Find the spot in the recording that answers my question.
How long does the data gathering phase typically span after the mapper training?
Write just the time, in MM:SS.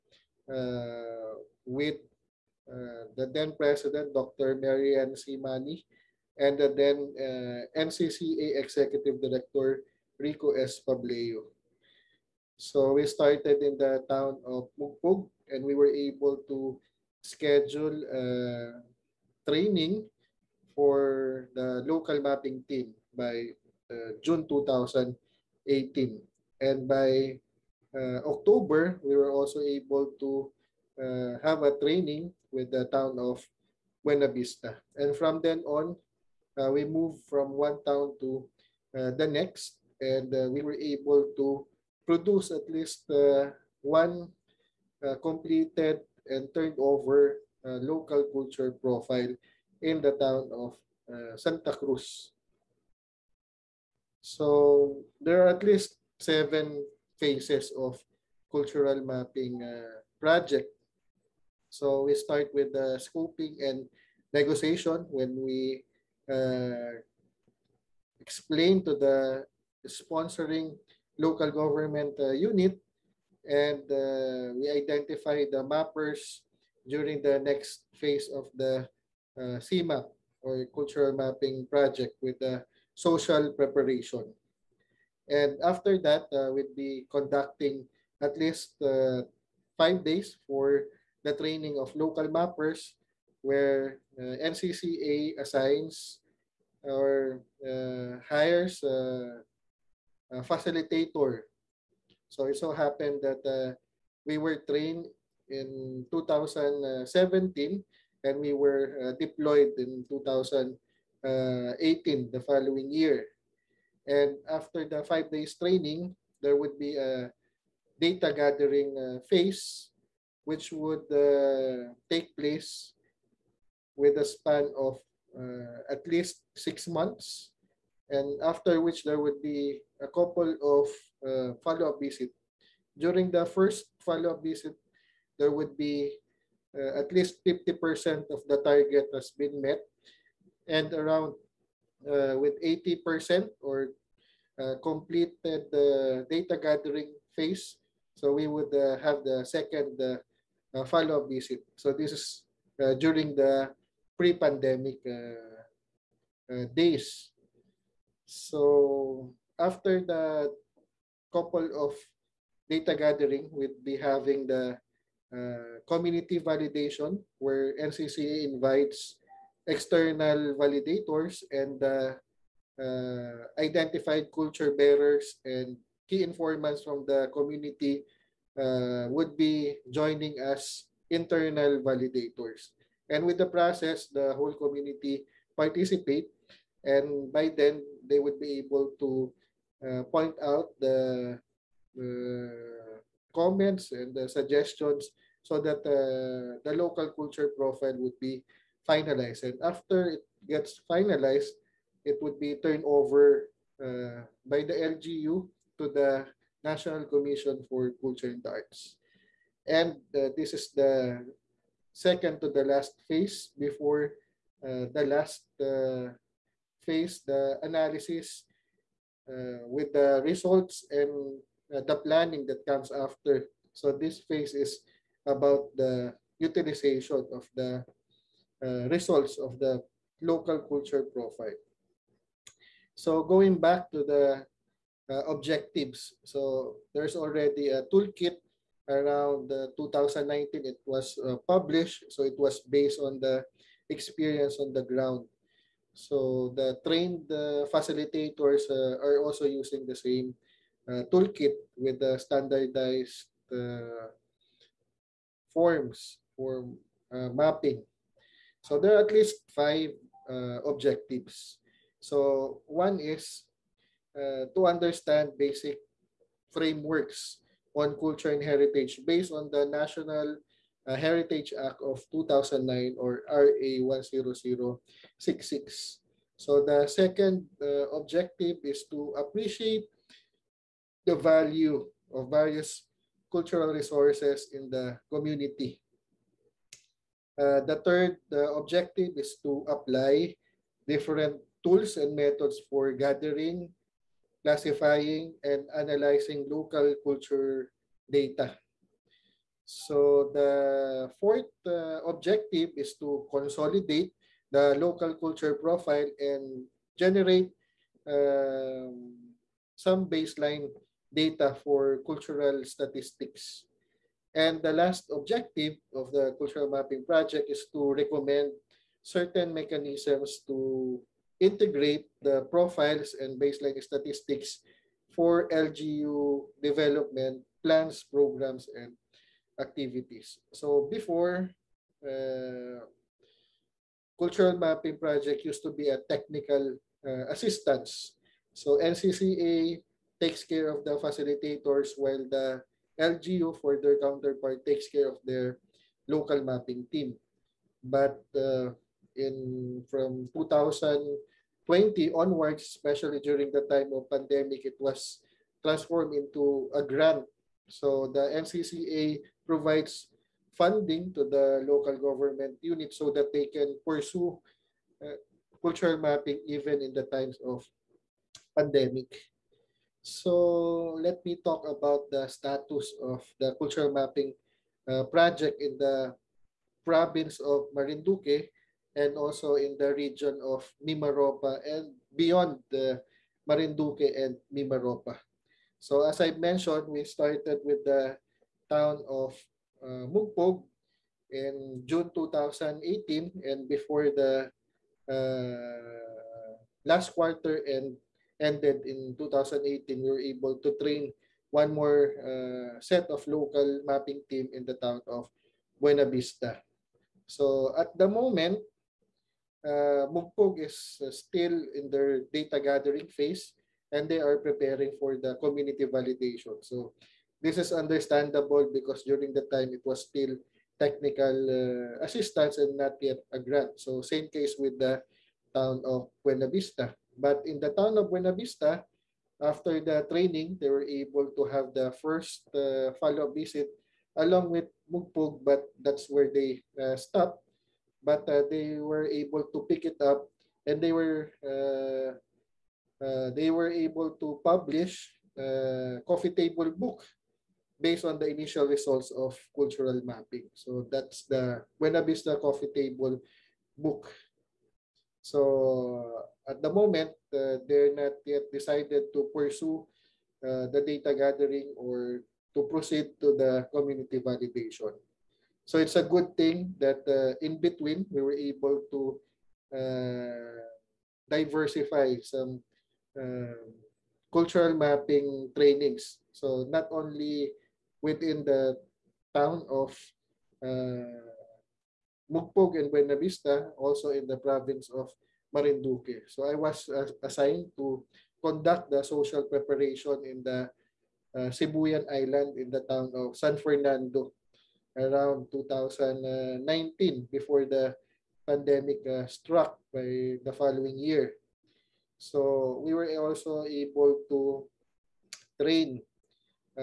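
02:06.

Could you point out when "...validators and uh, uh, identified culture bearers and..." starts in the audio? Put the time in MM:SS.
02:50.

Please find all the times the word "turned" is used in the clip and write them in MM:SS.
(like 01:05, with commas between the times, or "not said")
00:46, 03:22.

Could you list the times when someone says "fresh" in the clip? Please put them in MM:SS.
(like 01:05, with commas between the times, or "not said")
not said.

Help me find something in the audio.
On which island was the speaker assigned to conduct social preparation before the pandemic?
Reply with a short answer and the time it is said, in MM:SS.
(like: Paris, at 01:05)
Sibuyan Island, at 08:11.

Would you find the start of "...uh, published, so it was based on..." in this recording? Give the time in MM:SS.
04:01.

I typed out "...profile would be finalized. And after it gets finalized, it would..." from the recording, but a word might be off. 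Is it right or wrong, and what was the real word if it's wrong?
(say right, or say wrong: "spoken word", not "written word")
right.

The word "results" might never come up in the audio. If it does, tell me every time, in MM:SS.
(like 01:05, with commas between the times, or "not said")
03:40, 03:48, 07:28.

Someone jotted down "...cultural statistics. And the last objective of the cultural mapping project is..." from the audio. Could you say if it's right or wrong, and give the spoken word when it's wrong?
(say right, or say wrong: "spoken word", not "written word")
right.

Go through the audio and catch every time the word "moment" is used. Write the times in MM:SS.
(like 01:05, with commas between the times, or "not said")
06:48, 07:36.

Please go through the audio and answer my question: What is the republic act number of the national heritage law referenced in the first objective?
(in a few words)
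RA 10066.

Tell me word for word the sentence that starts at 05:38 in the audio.
So NCCA takes care of the facilitators while the LGU for their counterpart takes care of their local mapping team.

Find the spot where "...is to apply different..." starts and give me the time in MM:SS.
04:49.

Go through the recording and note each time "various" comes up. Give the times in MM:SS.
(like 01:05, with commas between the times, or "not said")
04:42.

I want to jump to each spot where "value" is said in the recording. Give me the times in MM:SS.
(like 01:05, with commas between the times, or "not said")
04:41.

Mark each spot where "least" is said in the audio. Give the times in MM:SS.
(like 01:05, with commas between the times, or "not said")
00:42, 00:55, 01:28, 02:06, 02:17, 04:19.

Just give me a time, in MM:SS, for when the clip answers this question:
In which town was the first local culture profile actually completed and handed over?
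00:51.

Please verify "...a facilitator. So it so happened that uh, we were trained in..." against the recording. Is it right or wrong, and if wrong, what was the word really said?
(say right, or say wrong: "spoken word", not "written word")
right.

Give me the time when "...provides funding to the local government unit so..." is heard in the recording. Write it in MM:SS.
05:59.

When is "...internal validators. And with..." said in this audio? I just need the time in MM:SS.
03:01.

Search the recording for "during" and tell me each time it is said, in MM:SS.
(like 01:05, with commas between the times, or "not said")
01:16, 02:12, 02:33, 05:53, 06:59.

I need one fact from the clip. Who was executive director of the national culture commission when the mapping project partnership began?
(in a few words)
Rico S. Pableo.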